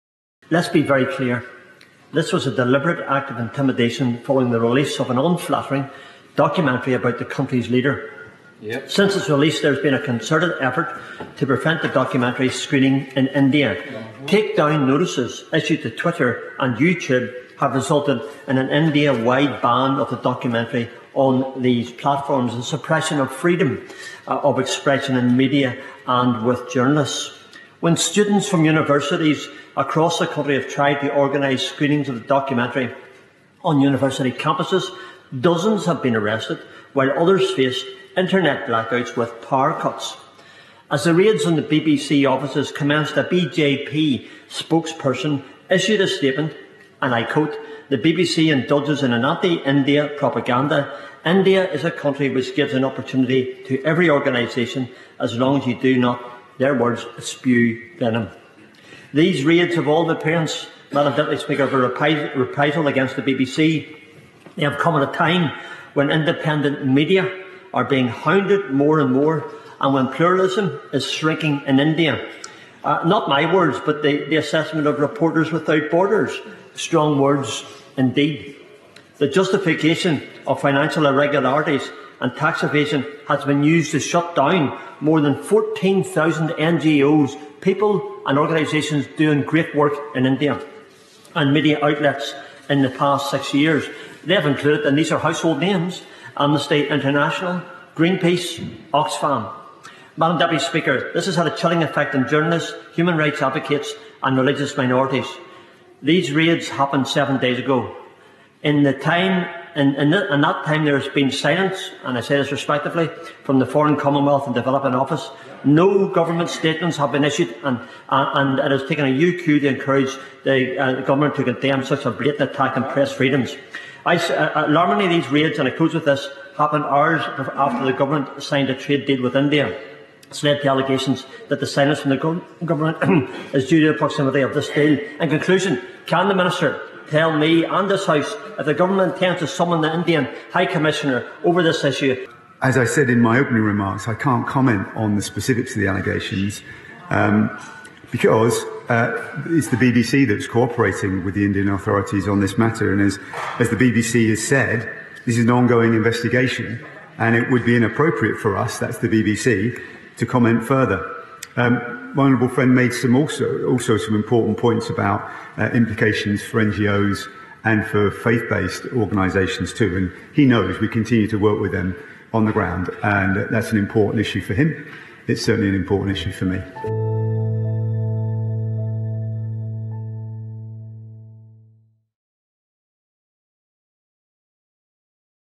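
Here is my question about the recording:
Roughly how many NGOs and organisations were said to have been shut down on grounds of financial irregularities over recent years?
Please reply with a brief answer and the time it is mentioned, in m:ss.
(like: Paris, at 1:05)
14,000, at 1:25.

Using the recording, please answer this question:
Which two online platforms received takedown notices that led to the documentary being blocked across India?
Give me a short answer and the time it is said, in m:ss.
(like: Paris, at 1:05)
Twitter and YouTube, at 0:15.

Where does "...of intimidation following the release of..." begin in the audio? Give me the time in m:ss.
0:03.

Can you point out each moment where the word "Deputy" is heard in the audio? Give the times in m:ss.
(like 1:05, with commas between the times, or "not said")
1:01, 1:40.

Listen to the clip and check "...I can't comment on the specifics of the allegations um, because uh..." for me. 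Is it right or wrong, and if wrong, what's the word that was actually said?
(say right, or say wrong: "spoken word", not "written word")
right.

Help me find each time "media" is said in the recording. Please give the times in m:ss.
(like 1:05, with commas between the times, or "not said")
0:25, 1:06, 1:31.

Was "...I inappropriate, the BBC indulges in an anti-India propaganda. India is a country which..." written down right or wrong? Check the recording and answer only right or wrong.
wrong.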